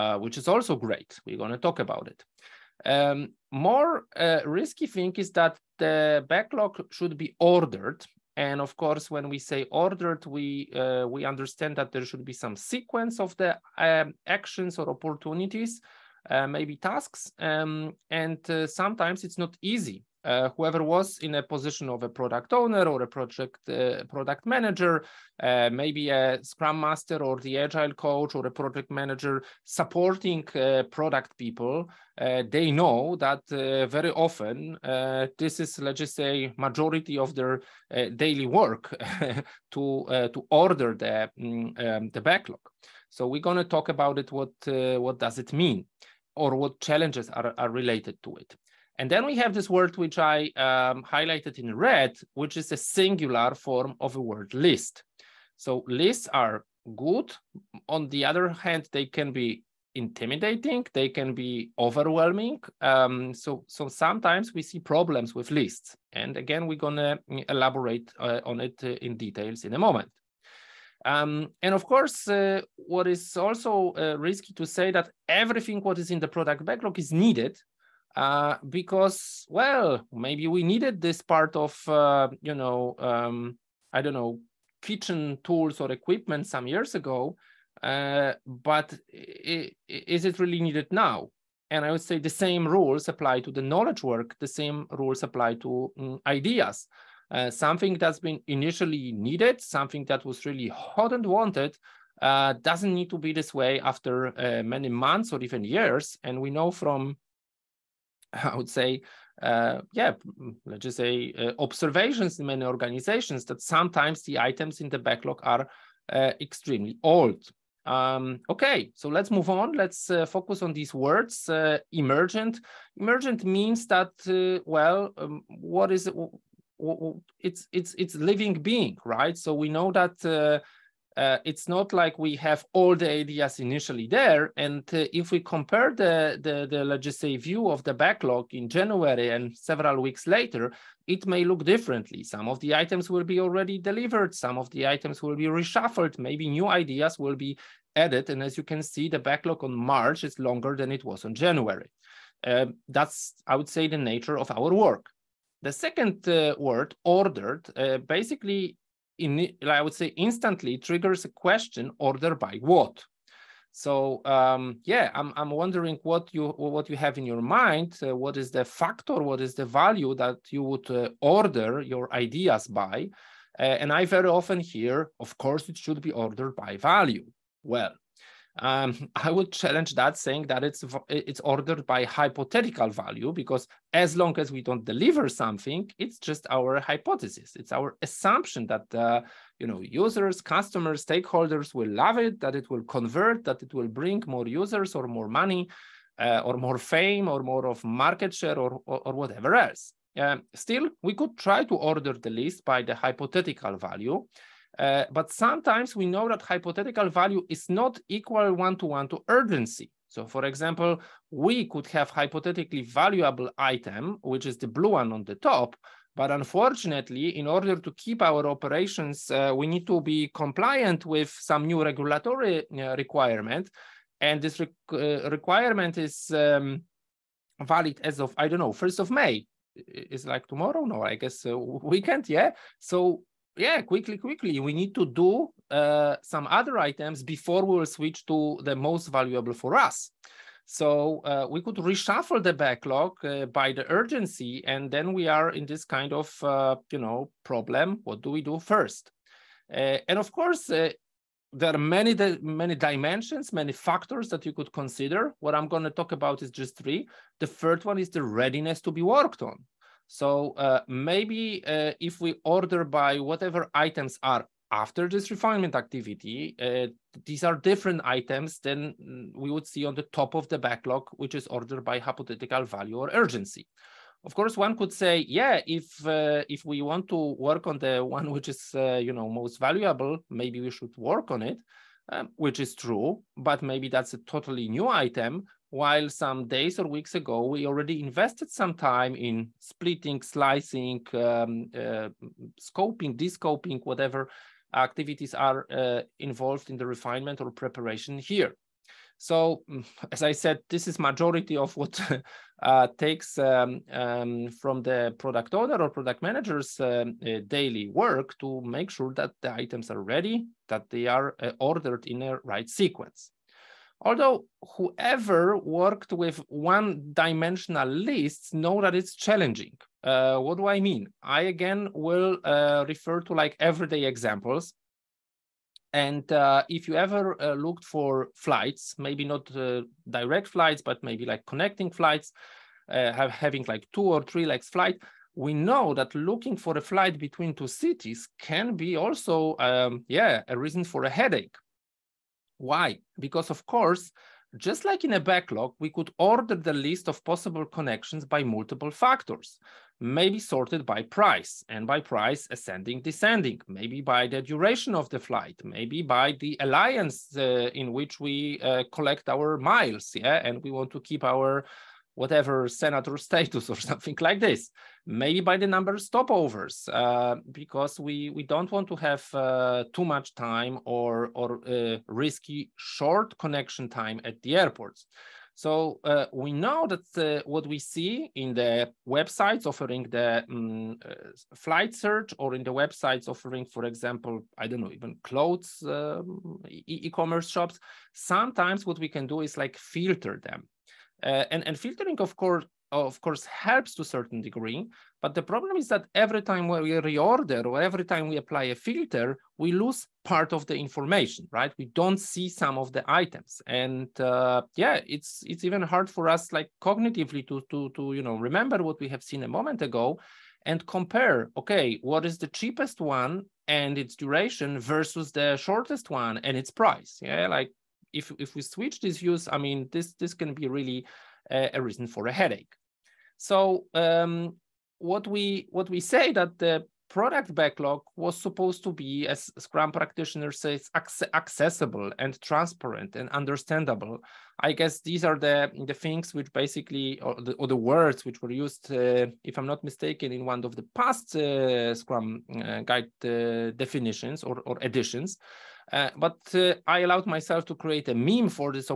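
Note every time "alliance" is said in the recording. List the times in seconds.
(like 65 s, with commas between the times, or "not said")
356 s.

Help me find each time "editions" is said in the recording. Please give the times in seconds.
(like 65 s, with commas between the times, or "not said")
444 s.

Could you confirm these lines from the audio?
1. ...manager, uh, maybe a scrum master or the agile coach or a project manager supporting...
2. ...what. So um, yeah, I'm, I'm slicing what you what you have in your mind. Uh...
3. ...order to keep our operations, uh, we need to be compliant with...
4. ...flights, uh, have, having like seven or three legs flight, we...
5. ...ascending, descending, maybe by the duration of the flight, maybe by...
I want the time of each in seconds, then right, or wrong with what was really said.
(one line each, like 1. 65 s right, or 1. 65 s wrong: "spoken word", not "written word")
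1. 24 s right
2. 162 s wrong: "wondering", not "slicing"
3. 217 s right
4. 331 s wrong: "two", not "seven"
5. 352 s right.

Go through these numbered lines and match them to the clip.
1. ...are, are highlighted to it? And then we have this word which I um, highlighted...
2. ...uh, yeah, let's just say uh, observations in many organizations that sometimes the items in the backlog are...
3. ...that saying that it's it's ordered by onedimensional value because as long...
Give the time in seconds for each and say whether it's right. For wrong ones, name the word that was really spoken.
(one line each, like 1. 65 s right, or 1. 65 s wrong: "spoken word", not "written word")
1. 47 s wrong: "related", not "highlighted"
2. 109 s right
3. 179 s wrong: "hypothetical", not "onedimensional".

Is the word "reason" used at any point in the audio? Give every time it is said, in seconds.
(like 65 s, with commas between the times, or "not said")
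340 s, 421 s.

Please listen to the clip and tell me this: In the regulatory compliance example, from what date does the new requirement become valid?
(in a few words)
1st of May.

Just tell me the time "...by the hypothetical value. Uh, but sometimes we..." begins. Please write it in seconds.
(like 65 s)
202 s.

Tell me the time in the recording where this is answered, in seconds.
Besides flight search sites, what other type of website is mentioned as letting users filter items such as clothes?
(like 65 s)
386 s.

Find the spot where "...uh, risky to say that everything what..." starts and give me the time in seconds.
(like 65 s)
73 s.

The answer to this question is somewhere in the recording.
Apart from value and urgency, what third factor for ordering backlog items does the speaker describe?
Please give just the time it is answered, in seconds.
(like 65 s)
258 s.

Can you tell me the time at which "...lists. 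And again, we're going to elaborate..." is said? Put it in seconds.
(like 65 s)
65 s.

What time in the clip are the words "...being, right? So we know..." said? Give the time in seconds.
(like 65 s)
128 s.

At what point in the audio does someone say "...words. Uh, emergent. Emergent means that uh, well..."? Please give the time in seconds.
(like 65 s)
120 s.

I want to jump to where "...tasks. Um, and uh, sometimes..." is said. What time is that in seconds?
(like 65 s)
16 s.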